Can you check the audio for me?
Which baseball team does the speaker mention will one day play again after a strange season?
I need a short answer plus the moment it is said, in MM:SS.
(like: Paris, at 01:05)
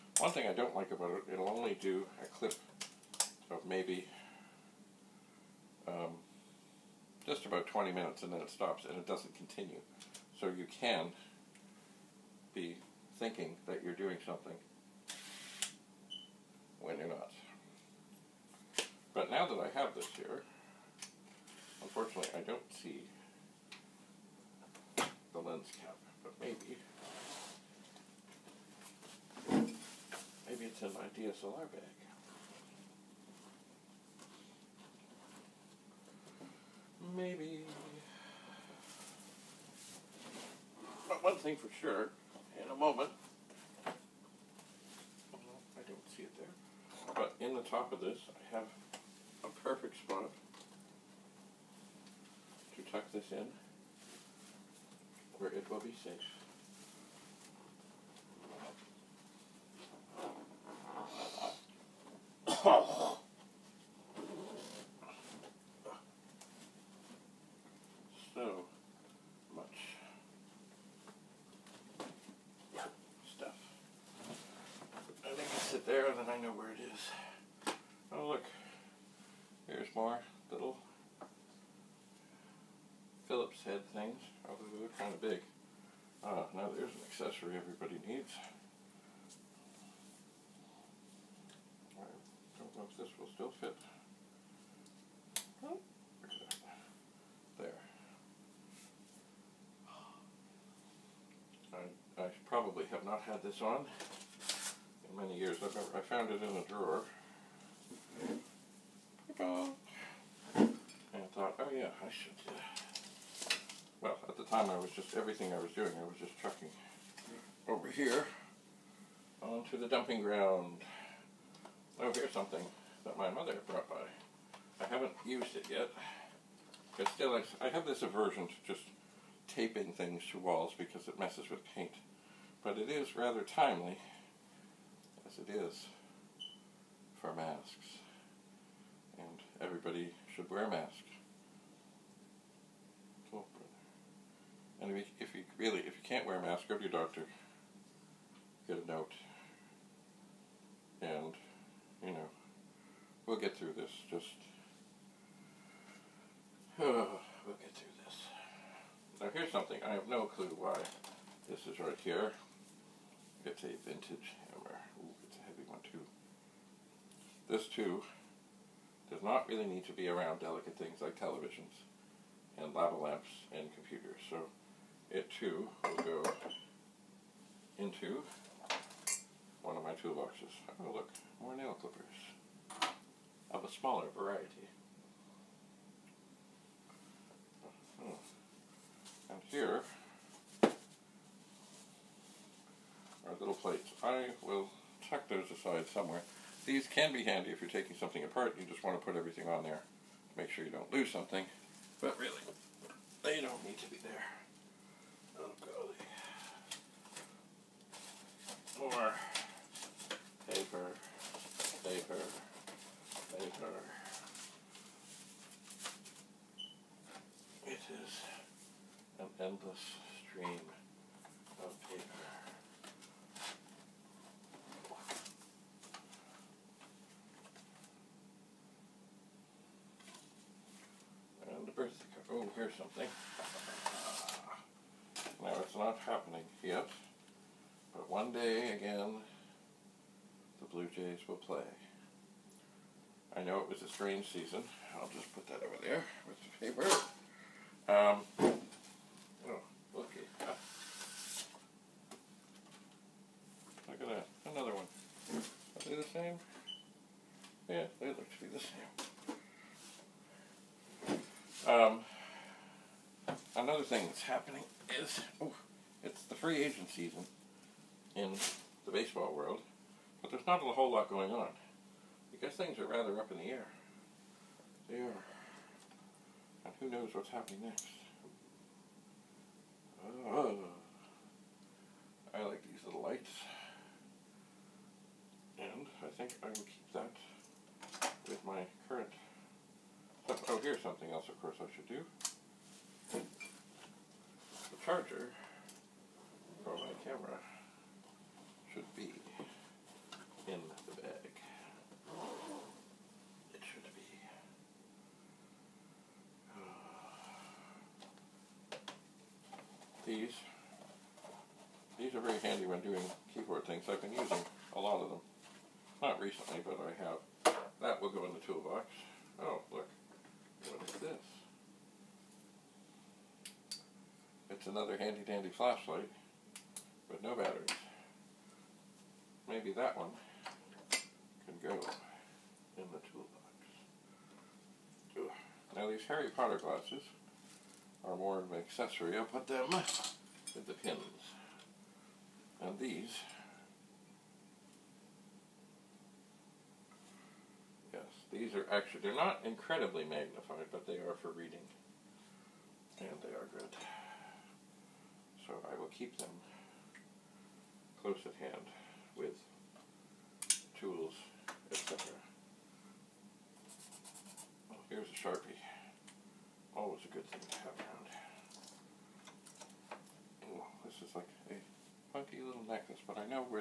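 Blue Jays, at 04:00.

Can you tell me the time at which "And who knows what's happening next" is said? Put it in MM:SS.
04:36.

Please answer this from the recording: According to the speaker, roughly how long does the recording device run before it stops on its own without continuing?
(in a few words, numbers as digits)
20 minutes.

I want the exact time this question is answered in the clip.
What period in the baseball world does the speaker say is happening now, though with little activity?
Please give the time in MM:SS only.
04:26.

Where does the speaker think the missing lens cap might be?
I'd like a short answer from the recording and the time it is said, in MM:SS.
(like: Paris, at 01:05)
DSLR bag, at 00:31.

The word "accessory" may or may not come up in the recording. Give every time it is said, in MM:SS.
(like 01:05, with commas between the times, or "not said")
01:27, 05:38.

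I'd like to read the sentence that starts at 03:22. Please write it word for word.
But really, they don't need to be there.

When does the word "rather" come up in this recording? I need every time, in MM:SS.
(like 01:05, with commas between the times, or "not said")
02:13, 04:32.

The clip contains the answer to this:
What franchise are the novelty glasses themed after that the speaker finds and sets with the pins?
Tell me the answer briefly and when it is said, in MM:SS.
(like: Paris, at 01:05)
Harry Potter, at 05:36.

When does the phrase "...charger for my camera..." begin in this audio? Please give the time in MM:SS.
04:54.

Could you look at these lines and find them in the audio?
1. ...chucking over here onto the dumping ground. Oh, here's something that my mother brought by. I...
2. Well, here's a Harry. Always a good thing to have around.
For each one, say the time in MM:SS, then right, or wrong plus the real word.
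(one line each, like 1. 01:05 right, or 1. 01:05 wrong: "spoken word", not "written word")
1. 01:56 right
2. 06:04 wrong: "Sharpie", not "Harry".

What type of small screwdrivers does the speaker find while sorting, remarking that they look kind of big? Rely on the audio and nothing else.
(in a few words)
Phillips head.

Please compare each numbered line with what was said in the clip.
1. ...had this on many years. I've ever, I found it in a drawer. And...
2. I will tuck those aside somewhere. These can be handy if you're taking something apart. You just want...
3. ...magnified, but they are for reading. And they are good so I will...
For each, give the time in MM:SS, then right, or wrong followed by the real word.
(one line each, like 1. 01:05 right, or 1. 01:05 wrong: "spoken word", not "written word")
1. 01:43 right
2. 03:14 right
3. 05:50 right.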